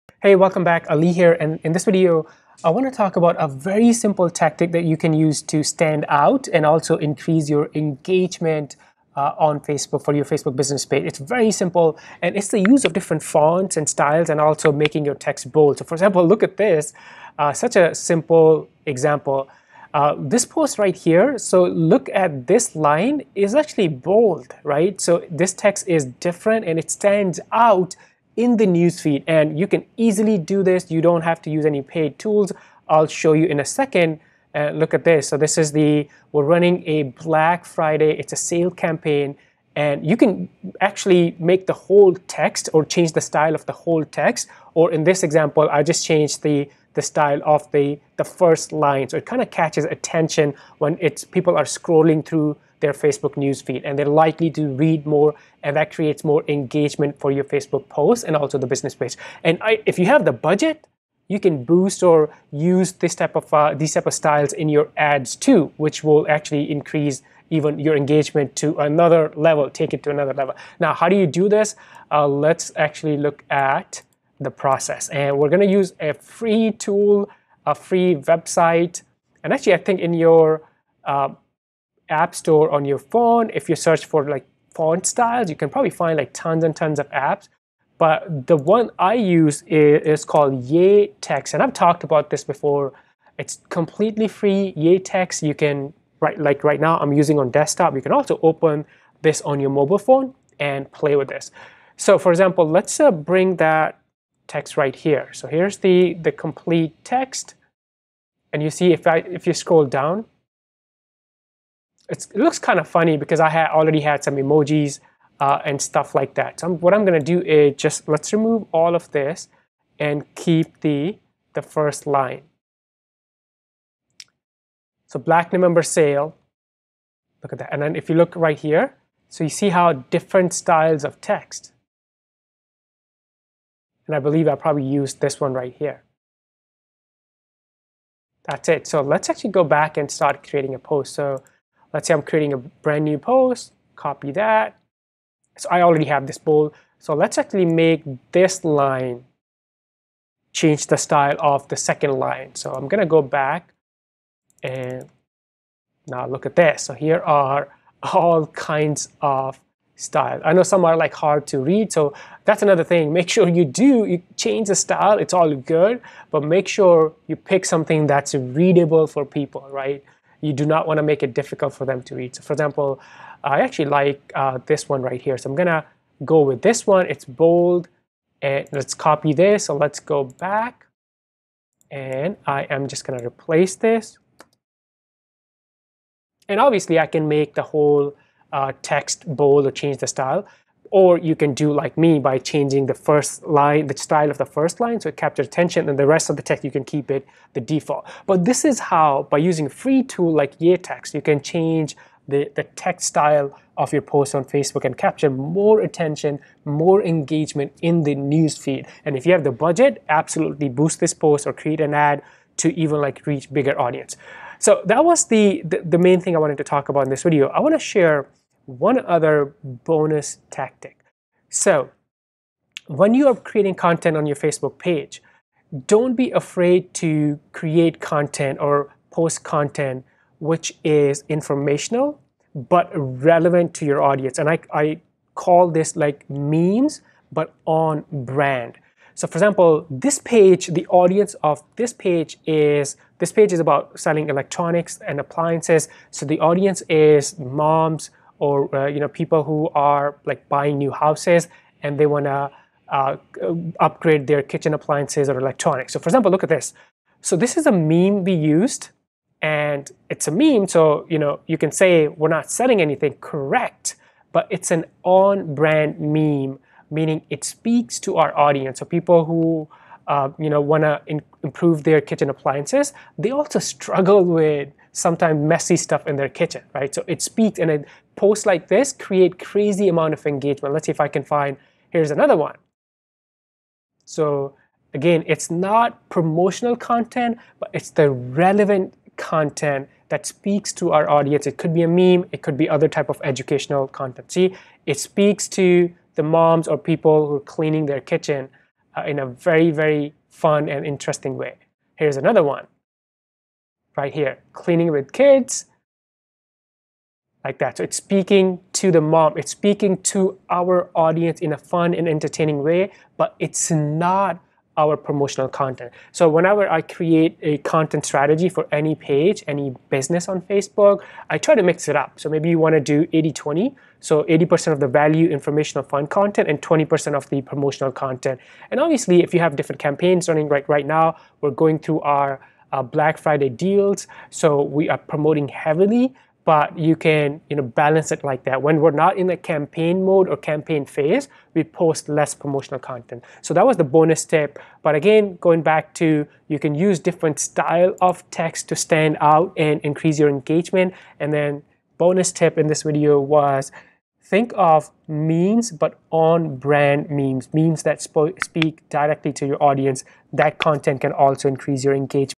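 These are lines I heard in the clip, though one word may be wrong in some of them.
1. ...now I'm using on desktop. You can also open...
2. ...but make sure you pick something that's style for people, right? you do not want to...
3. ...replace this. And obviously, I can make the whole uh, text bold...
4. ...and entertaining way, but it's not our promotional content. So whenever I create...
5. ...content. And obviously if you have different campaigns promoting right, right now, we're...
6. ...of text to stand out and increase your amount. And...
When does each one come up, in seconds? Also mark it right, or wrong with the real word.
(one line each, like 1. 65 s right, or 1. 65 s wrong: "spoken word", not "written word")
1. 96 s right
2. 166 s wrong: "readable", not "style"
3. 183 s right
4. 311 s right
5. 327 s wrong: "running", not "promoting"
6. 348 s wrong: "engagement", not "amount".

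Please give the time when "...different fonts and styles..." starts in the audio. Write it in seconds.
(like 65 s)
12 s.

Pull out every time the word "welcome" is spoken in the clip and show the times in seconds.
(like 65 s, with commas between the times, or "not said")
0 s.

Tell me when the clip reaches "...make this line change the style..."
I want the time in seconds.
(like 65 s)
147 s.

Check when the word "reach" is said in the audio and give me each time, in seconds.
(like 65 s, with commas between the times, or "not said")
213 s.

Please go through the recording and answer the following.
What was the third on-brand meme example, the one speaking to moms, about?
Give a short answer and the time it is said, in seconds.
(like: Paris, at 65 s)
cleaning with kids, at 304 s.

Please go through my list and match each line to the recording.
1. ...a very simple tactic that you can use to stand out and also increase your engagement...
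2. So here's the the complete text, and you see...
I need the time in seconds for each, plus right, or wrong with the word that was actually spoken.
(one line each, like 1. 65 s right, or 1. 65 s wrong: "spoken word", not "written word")
1. 3 s right
2. 105 s right.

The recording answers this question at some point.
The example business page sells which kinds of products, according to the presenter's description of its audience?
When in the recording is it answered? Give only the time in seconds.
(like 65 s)
244 s.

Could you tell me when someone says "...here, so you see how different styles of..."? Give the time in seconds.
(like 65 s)
128 s.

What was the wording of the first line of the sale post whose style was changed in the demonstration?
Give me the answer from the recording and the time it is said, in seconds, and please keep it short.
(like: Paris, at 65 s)
Black November sale, at 125 s.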